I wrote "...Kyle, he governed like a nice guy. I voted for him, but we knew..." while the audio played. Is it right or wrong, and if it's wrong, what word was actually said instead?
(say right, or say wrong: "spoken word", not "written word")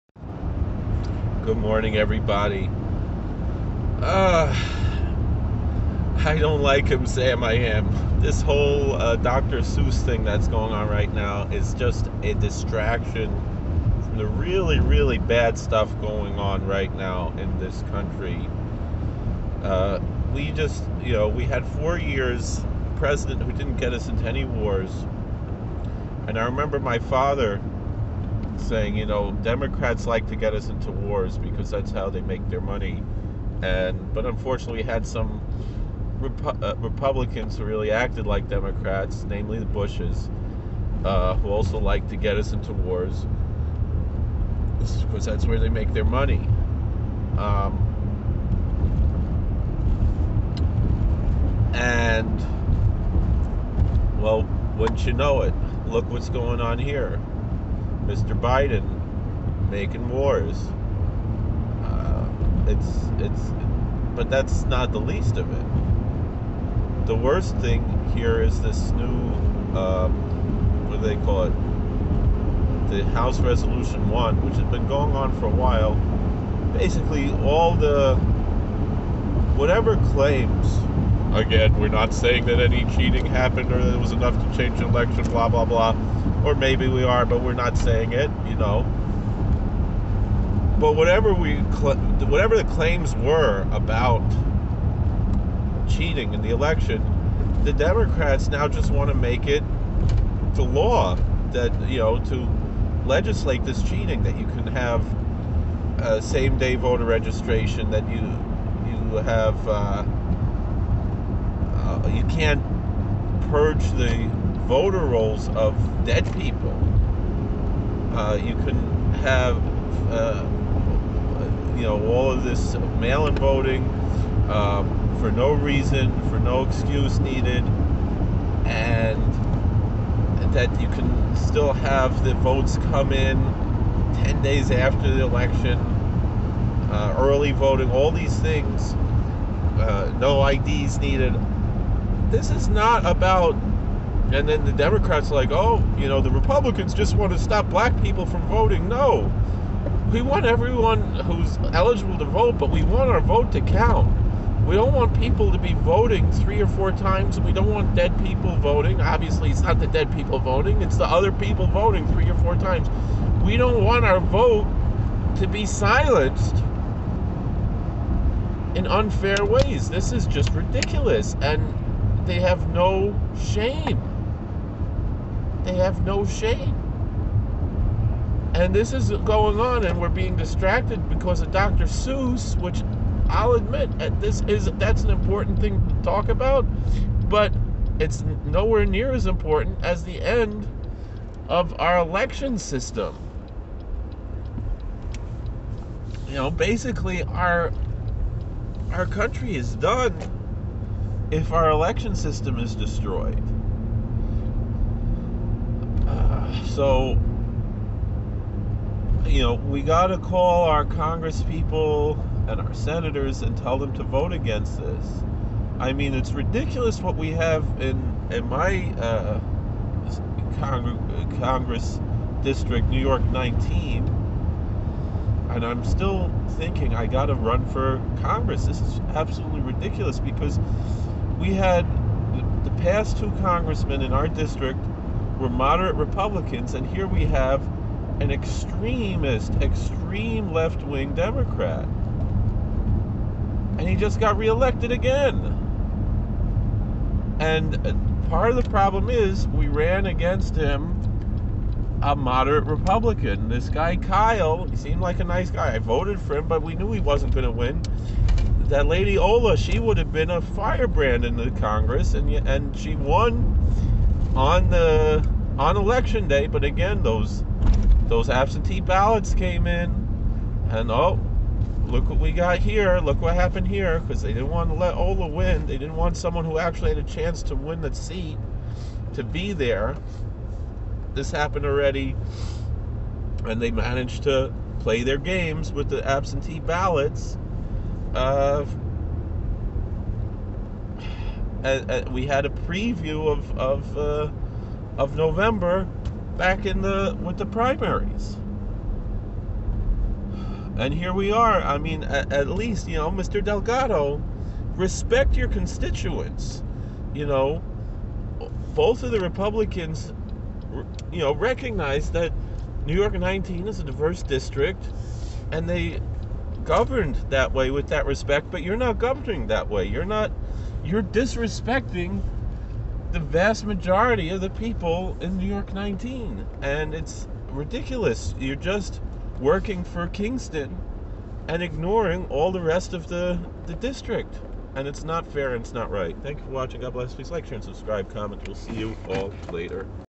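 wrong: "seemed", not "governed".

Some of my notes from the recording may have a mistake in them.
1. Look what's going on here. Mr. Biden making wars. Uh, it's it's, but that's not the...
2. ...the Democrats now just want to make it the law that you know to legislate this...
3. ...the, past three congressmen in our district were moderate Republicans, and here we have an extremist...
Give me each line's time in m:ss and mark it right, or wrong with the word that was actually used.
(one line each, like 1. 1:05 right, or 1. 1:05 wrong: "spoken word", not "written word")
1. 0:55 right
2. 1:37 right
3. 3:52 wrong: "two", not "three".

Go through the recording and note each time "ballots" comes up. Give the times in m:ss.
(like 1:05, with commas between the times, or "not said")
4:28, 4:46.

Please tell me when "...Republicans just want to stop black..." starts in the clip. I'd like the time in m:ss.
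2:26.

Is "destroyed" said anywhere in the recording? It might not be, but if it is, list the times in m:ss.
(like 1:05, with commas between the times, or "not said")
3:22.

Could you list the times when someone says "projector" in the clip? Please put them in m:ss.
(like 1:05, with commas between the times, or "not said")
not said.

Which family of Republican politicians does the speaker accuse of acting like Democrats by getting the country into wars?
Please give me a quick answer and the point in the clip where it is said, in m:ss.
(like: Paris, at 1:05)
The Bushes, at 0:39.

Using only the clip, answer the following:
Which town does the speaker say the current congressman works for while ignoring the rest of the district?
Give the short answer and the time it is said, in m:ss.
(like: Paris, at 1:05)
Kingston, at 5:30.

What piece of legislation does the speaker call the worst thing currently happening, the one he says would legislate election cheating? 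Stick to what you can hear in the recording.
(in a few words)
House Resolution One.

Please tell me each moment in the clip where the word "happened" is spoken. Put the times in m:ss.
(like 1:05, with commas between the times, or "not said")
1:23, 4:33, 4:41.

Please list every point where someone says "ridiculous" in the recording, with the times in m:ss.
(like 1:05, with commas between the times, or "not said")
2:50, 3:36, 3:49, 5:27.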